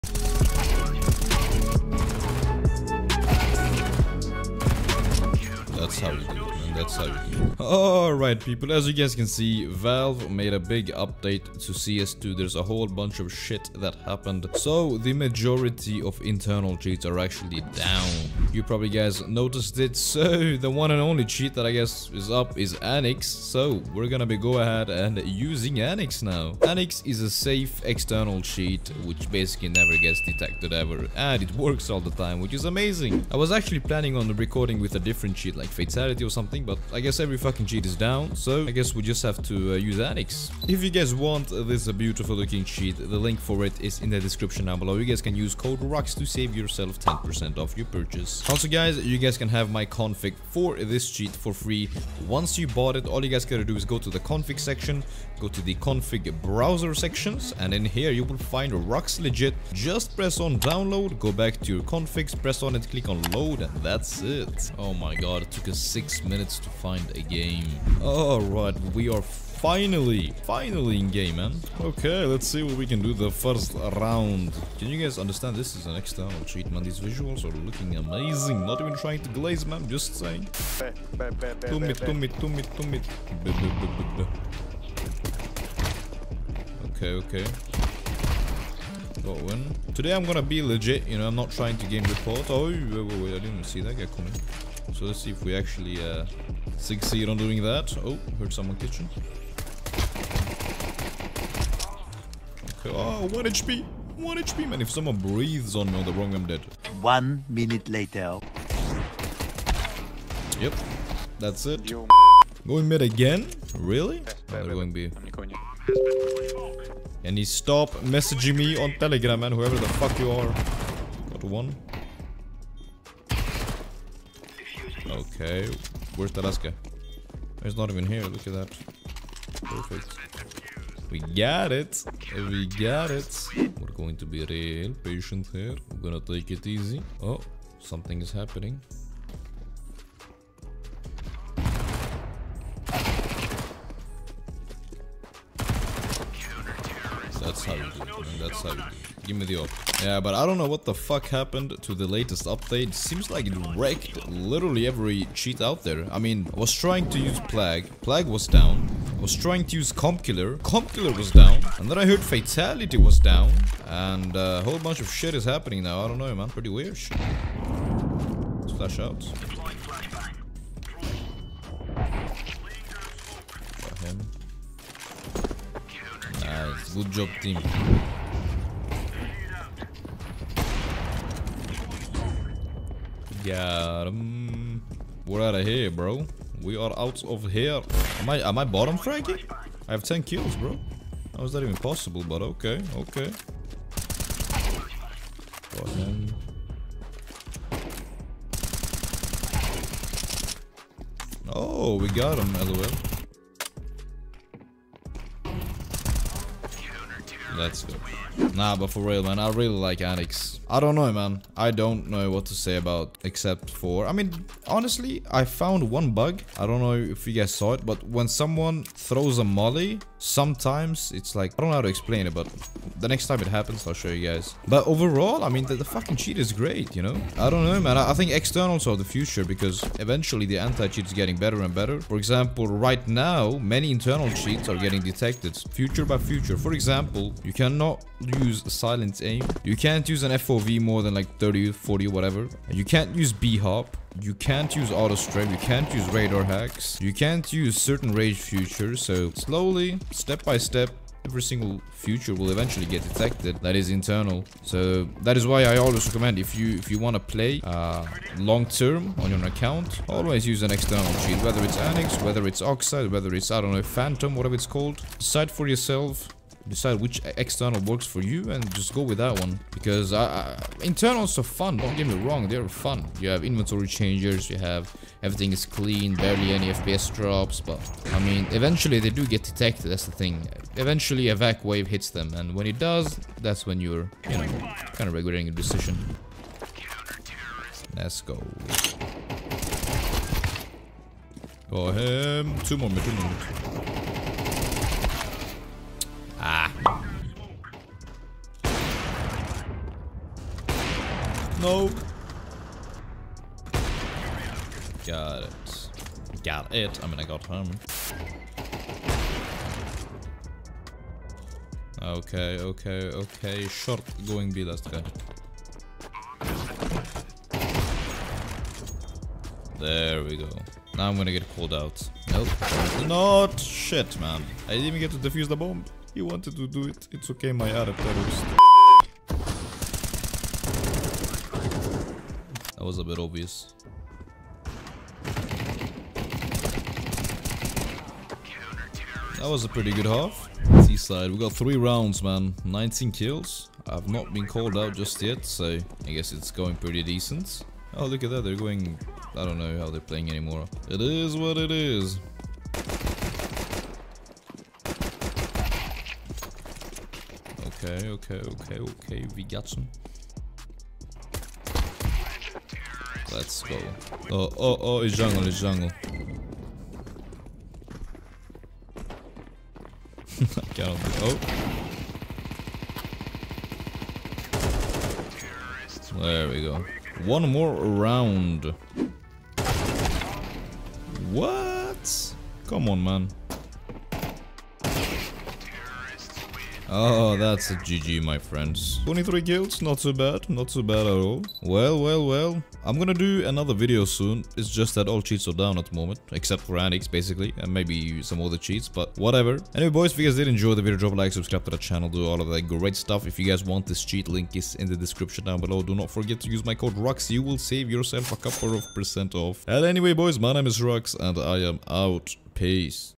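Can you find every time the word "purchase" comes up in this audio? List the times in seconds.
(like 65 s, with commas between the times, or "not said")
47 s.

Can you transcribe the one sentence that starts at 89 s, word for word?
Today I'm gonna be legit, you know, I'm not trying to game report.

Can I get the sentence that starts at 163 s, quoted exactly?
And uh, a whole bunch of shit is happening now.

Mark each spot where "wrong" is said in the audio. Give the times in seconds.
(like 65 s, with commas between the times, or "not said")
106 s, 272 s.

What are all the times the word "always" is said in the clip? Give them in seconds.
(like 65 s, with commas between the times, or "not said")
255 s, 260 s.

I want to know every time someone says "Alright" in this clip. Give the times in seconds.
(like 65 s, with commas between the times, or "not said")
7 s, 68 s.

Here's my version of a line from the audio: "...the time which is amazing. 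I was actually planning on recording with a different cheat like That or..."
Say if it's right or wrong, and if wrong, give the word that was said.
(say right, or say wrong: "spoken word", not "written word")
wrong: "Fatality", not "That".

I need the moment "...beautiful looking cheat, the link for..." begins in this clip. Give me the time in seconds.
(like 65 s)
41 s.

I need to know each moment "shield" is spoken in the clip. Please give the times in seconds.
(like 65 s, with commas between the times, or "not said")
261 s.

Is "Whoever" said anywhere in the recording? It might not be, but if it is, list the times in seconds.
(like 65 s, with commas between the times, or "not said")
119 s.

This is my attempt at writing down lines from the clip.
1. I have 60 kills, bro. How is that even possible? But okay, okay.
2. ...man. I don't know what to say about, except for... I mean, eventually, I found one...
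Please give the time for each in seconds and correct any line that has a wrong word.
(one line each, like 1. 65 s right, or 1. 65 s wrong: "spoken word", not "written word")
1. 189 s wrong: "10", not "60"
2. 211 s wrong: "honestly", not "eventually".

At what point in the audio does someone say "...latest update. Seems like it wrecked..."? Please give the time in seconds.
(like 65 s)
152 s.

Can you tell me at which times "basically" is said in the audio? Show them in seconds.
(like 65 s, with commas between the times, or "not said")
29 s, 397 s.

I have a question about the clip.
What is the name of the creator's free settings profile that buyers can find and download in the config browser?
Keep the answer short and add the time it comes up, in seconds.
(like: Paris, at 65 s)
RUX Legit, at 58 s.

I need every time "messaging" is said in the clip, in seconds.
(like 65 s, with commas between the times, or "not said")
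118 s.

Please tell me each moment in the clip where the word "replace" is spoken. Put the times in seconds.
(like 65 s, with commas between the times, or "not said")
not said.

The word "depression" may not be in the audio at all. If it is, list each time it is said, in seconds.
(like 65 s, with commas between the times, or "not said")
not said.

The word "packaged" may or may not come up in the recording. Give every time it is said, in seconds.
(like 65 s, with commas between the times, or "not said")
not said.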